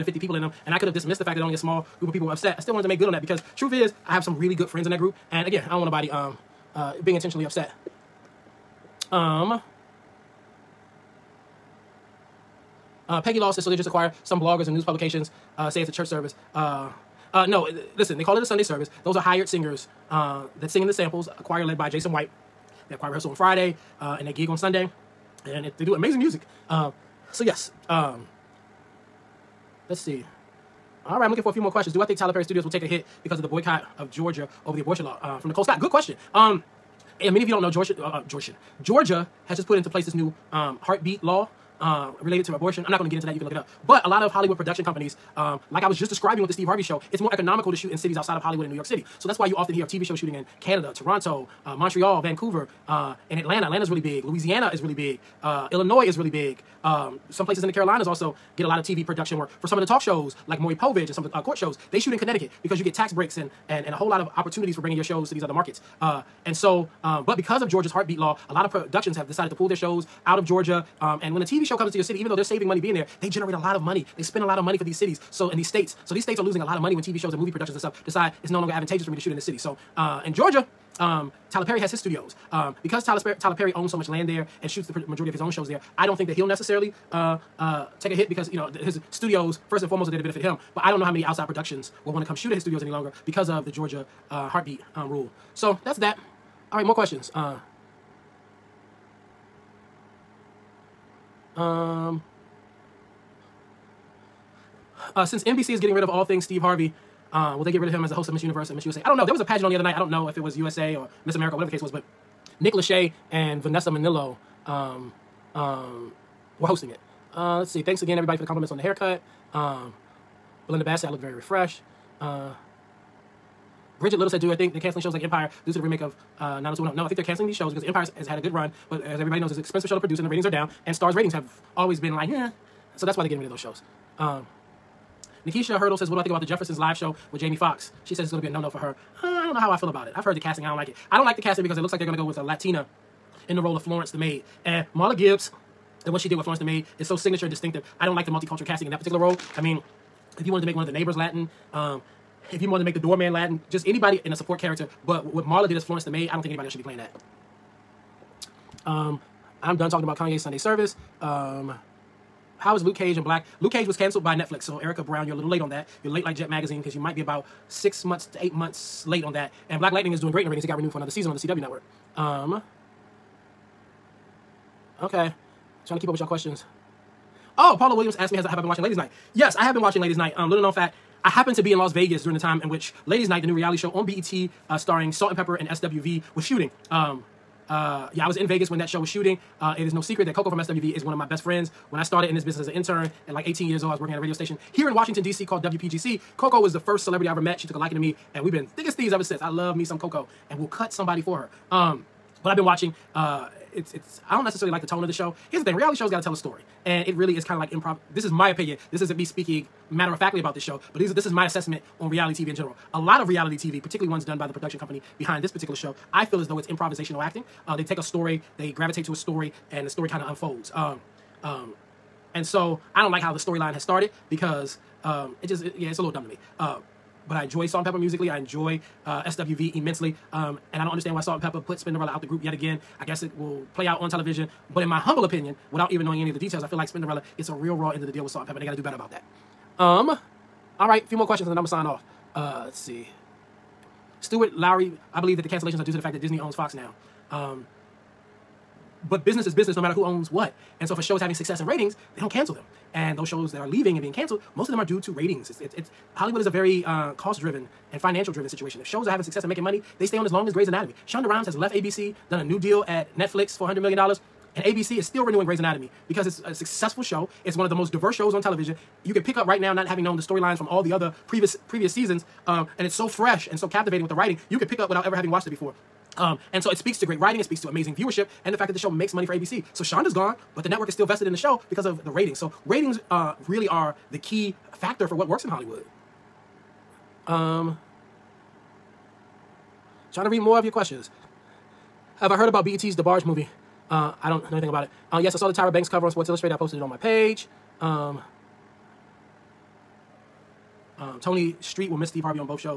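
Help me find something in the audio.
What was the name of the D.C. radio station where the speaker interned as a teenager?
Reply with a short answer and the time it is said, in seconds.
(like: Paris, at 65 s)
WPGC, at 195 s.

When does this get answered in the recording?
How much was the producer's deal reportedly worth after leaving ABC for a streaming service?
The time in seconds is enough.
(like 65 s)
263 s.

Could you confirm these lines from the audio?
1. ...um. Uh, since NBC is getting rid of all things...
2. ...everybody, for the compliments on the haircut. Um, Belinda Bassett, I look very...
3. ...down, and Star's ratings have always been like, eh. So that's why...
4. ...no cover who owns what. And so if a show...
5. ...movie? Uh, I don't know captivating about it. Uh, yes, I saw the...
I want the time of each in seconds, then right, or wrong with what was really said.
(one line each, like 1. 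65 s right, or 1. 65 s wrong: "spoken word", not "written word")
1. 101 s right
2. 118 s right
3. 130 s right
4. 249 s wrong: "matter", not "cover"
5. 293 s wrong: "anything", not "captivating".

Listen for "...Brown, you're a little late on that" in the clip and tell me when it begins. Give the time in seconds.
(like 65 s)
165 s.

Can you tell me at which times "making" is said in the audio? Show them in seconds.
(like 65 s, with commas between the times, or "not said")
259 s.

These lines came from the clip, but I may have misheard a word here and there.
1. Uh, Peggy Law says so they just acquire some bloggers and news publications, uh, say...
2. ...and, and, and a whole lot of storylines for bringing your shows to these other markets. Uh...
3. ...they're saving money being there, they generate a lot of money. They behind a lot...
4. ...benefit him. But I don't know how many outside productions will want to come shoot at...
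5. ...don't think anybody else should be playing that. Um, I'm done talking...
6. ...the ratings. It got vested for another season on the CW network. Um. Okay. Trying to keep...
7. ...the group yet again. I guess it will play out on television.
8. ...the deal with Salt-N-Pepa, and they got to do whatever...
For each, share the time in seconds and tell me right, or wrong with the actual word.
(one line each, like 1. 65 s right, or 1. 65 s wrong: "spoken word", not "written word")
1. 13 s right
2. 63 s wrong: "opportunities", not "storylines"
3. 72 s wrong: "spend", not "behind"
4. 90 s right
5. 156 s right
6. 170 s wrong: "renewed", not "vested"
7. 232 s right
8. 238 s wrong: "better", not "whatever".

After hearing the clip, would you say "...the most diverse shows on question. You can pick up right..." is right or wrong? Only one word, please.
wrong.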